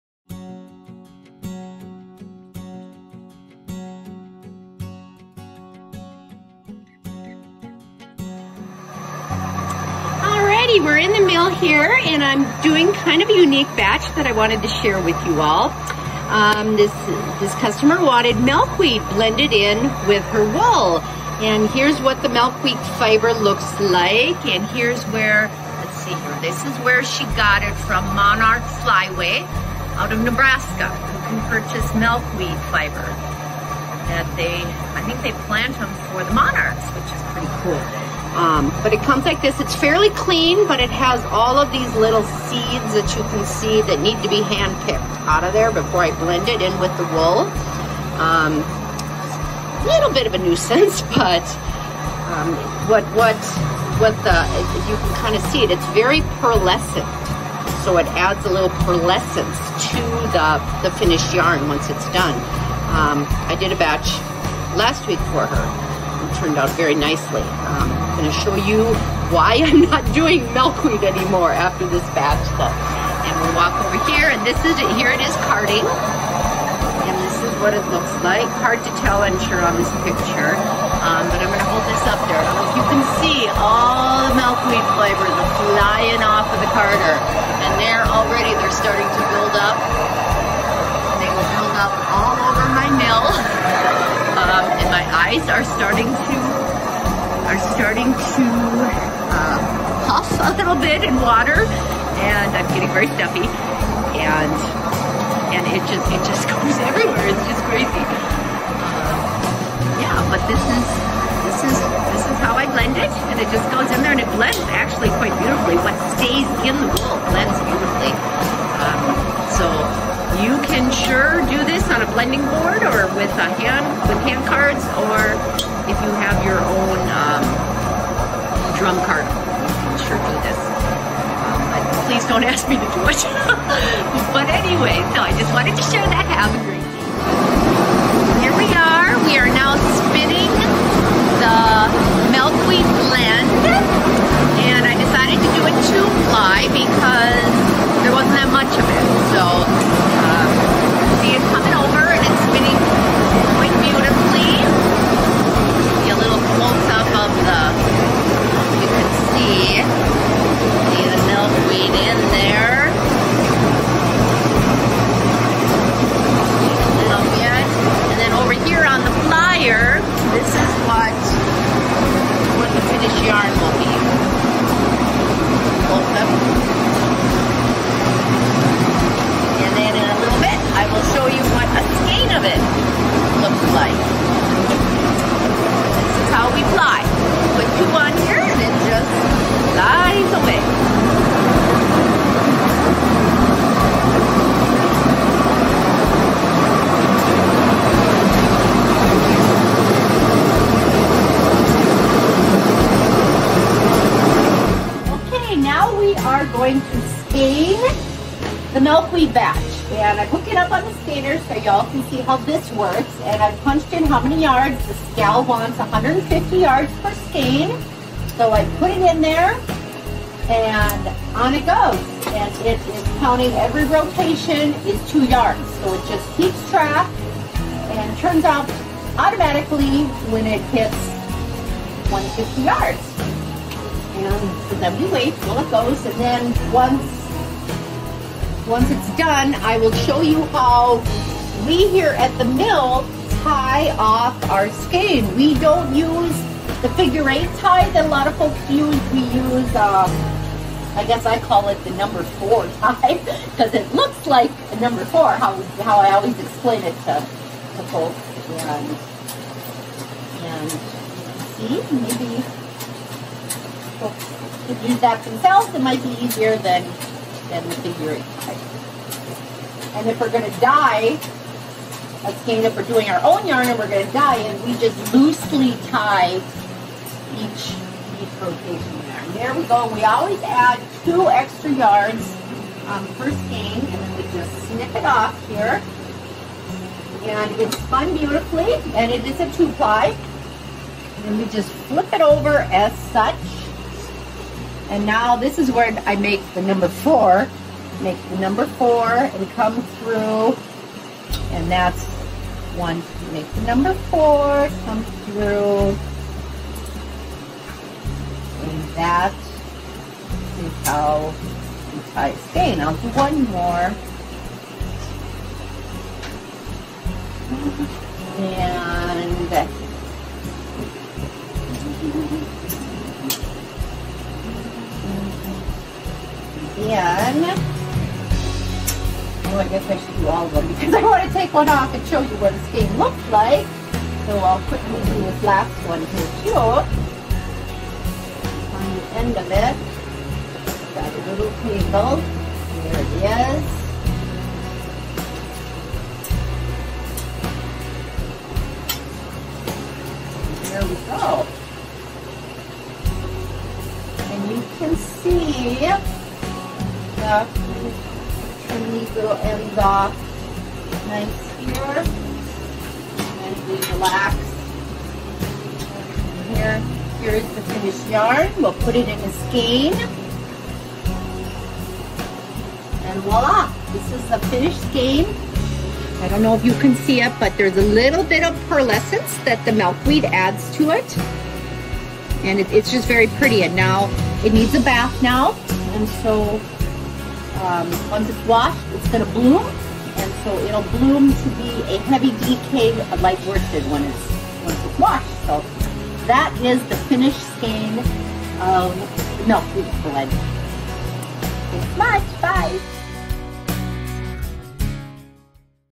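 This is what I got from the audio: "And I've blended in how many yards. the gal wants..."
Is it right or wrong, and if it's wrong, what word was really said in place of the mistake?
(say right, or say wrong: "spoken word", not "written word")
wrong: "punched", not "blended".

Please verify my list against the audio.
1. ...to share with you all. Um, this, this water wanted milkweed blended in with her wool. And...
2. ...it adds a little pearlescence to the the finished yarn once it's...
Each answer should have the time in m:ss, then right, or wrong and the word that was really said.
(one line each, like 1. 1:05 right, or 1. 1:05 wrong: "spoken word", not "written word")
1. 0:14 wrong: "customer", not "water"
2. 0:57 right.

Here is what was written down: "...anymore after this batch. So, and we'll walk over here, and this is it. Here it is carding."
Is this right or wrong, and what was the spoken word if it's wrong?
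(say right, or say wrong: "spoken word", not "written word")
right.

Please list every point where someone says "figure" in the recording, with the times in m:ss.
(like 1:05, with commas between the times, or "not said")
4:06, 4:27.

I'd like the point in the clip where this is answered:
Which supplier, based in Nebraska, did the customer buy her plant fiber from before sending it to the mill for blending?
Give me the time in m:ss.
0:28.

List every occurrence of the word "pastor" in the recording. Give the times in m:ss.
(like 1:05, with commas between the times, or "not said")
not said.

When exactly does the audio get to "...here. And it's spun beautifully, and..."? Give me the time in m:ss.
4:45.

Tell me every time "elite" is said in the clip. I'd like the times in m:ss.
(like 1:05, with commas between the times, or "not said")
not said.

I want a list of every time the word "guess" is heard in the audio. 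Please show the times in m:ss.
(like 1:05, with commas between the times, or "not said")
4:11, 5:29.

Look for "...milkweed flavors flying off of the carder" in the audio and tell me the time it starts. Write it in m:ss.
1:24.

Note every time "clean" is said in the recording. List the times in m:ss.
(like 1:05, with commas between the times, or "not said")
0:40.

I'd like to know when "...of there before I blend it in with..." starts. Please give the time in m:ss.
0:45.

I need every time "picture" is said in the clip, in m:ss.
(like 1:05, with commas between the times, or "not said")
1:20.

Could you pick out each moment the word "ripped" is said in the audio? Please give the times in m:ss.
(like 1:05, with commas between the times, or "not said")
not said.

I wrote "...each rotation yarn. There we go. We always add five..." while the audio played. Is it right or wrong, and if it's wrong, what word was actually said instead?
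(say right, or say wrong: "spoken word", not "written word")
wrong: "two", not "five".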